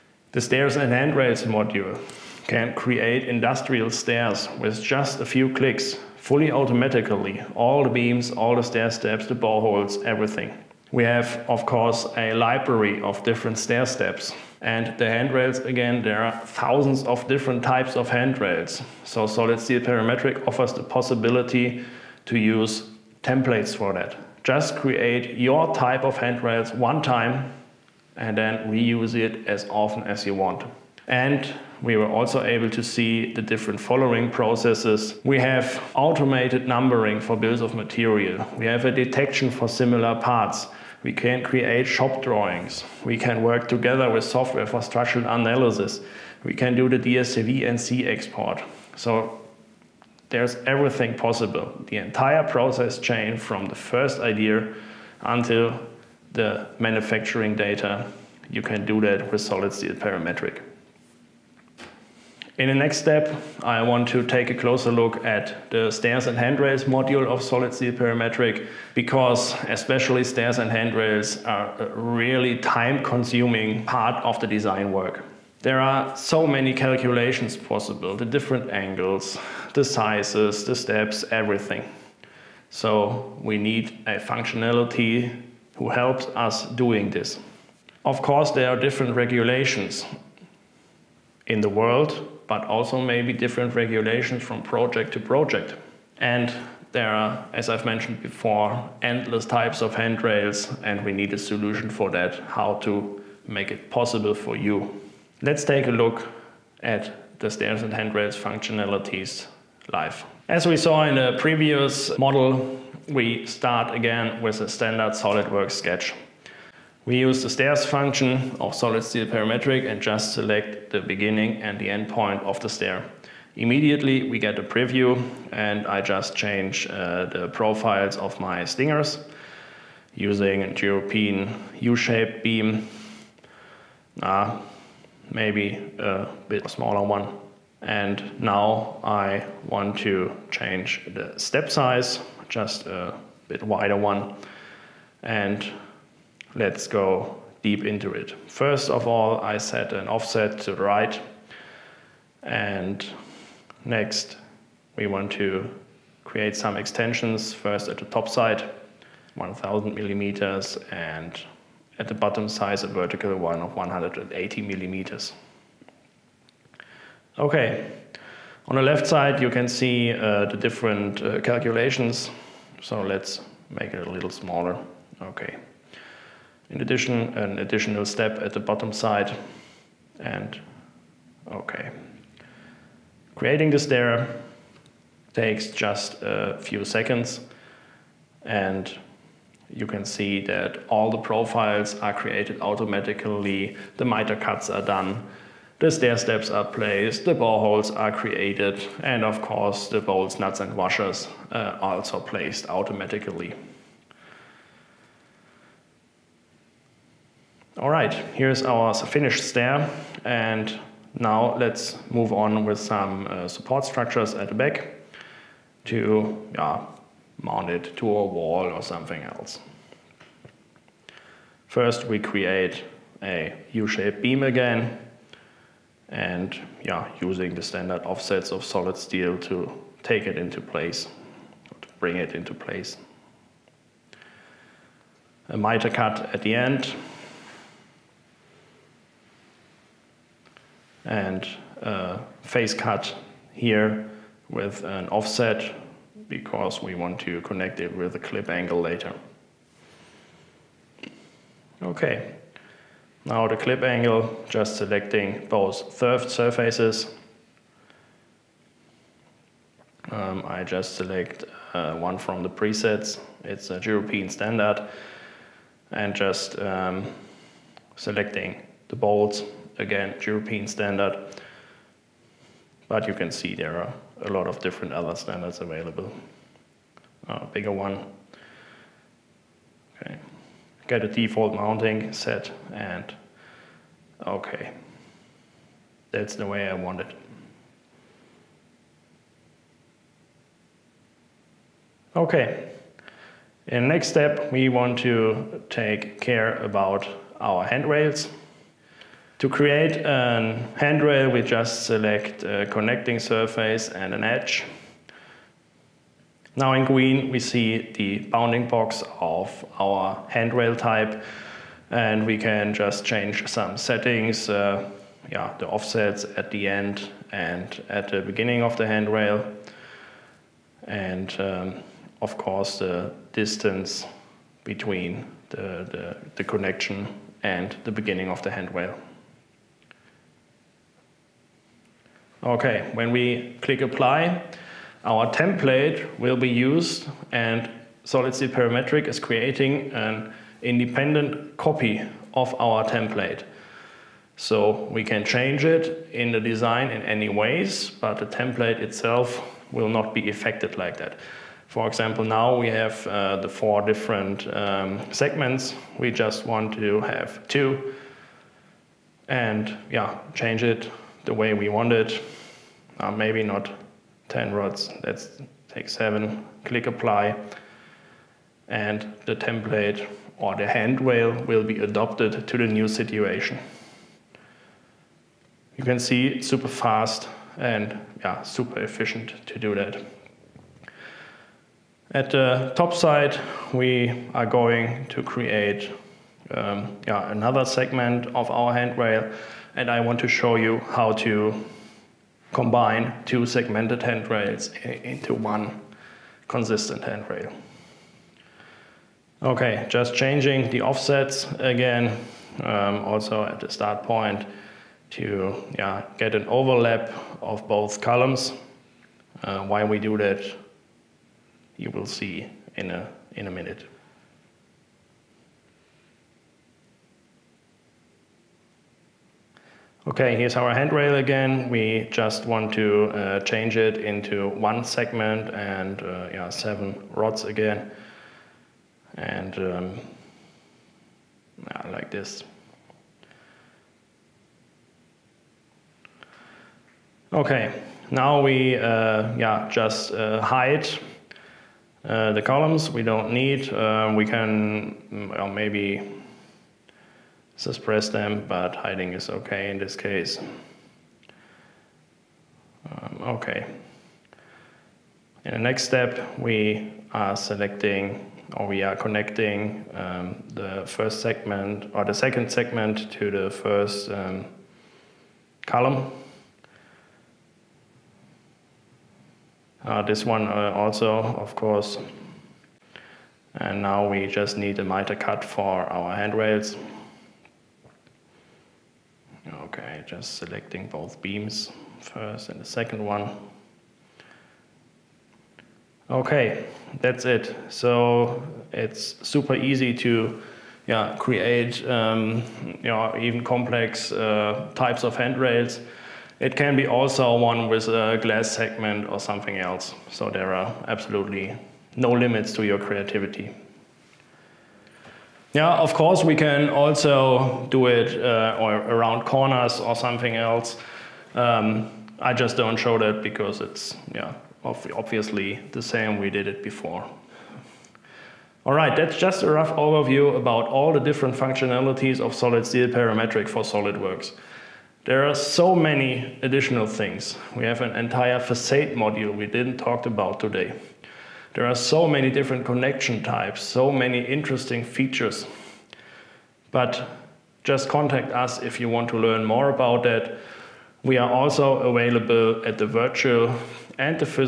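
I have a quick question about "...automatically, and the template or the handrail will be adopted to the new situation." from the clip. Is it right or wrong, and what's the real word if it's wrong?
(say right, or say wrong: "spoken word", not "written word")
wrong: "apply", not "automatically".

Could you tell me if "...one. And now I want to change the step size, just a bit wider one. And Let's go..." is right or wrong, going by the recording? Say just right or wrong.
right.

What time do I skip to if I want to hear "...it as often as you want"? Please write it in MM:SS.
00:29.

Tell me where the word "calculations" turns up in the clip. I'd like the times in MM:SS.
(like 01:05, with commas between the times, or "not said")
01:16, 02:51.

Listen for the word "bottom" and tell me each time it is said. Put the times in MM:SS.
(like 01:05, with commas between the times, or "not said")
02:42, 02:58.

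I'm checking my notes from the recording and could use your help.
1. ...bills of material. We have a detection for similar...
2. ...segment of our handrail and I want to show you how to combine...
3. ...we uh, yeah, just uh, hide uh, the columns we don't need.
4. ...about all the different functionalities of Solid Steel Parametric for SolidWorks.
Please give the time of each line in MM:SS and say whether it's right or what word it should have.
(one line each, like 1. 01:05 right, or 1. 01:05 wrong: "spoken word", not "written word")
1. 00:37 right
2. 06:27 right
3. 07:18 right
4. 08:40 right.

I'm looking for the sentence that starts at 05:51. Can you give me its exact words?
For example, now we have uh, the four different um, segments.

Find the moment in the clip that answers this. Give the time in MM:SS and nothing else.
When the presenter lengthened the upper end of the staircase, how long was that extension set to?
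02:39.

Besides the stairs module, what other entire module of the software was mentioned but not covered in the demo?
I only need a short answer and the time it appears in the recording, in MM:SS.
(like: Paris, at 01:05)
facade module, at 08:48.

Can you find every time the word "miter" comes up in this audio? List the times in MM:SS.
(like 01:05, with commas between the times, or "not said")
03:14, 03:55, 07:54.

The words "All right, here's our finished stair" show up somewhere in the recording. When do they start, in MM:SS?
03:27.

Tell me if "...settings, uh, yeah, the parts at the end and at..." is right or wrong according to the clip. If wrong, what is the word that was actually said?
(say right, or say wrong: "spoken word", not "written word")
wrong: "offsets", not "parts".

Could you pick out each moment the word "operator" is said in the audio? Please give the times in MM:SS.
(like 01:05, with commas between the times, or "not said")
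not said.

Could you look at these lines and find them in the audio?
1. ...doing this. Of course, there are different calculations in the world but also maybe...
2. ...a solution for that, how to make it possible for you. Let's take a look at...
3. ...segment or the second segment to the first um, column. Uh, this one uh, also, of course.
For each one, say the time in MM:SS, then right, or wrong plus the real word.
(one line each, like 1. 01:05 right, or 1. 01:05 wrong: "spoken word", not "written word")
1. 01:26 wrong: "regulations", not "calculations"
2. 01:41 right
3. 07:41 right.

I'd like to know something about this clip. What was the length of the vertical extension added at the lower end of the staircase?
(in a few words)
180 millimeters.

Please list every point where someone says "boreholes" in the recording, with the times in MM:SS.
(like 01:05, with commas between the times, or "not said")
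00:09, 03:17.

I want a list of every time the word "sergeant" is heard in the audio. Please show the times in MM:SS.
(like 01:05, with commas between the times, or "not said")
not said.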